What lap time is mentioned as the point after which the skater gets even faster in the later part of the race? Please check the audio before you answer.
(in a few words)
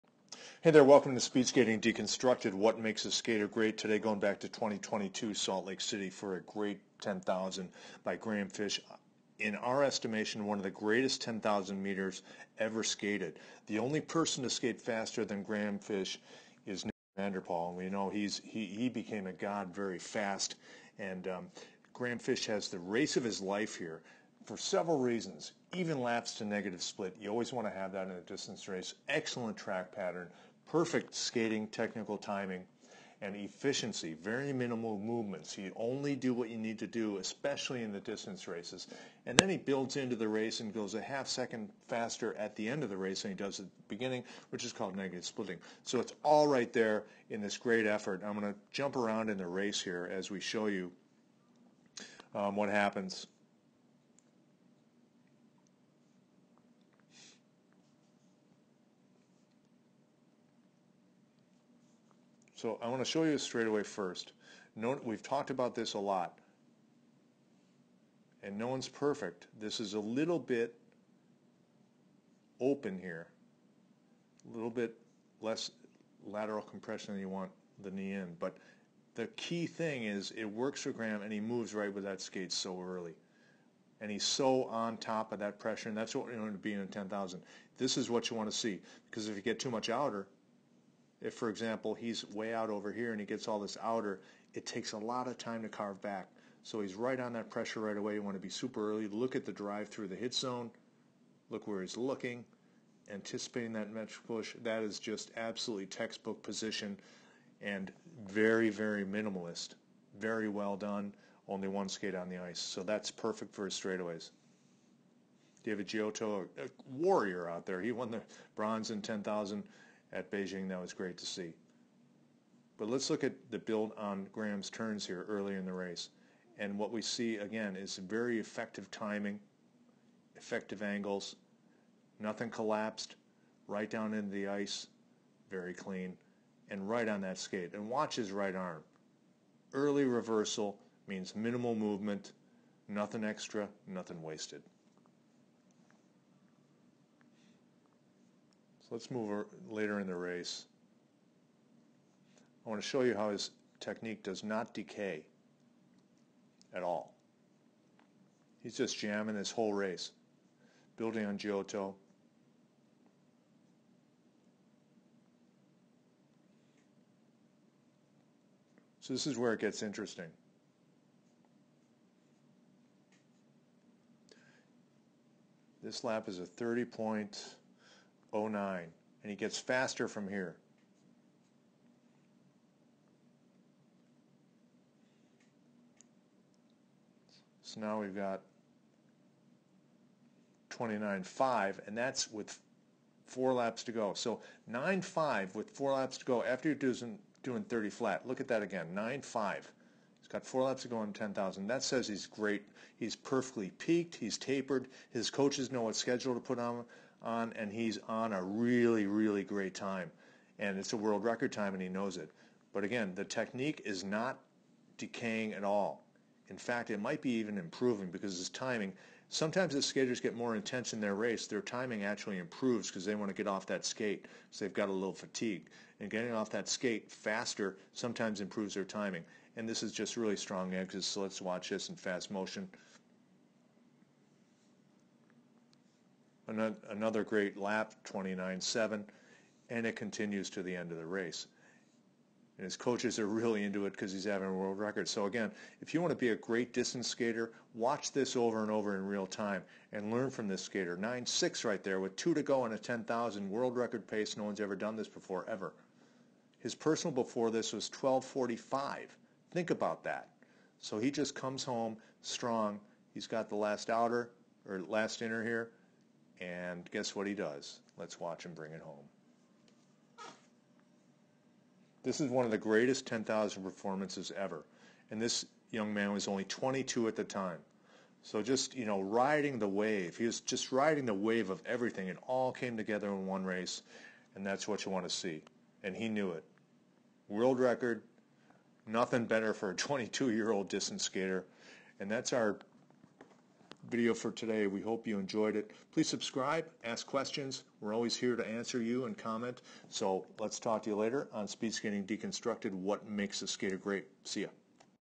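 30.09.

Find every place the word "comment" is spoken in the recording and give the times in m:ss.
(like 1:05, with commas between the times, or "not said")
4:59.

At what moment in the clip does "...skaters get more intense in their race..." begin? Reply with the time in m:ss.
3:39.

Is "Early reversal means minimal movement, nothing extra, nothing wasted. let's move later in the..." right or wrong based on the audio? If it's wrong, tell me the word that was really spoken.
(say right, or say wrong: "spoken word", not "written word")
right.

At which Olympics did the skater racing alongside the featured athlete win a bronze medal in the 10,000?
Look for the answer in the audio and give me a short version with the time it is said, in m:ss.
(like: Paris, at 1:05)
Beijing, at 2:00.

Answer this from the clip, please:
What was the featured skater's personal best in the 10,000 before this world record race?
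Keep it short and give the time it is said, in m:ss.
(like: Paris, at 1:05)
12.45, at 4:17.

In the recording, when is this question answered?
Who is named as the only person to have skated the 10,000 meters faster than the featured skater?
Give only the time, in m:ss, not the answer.
0:16.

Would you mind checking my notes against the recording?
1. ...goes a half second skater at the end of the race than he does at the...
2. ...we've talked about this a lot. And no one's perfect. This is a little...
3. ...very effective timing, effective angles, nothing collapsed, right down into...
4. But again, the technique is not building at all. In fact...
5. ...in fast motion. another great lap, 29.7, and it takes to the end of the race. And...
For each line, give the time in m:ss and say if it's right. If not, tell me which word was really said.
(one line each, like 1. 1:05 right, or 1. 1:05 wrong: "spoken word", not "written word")
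1. 0:40 wrong: "faster", not "skater"
2. 1:05 right
3. 2:07 right
4. 3:32 wrong: "decaying", not "building"
5. 3:51 wrong: "continues", not "takes".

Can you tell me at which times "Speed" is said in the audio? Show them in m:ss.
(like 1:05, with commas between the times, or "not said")
0:01, 5:01.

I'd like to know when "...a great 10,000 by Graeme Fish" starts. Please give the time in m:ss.
0:06.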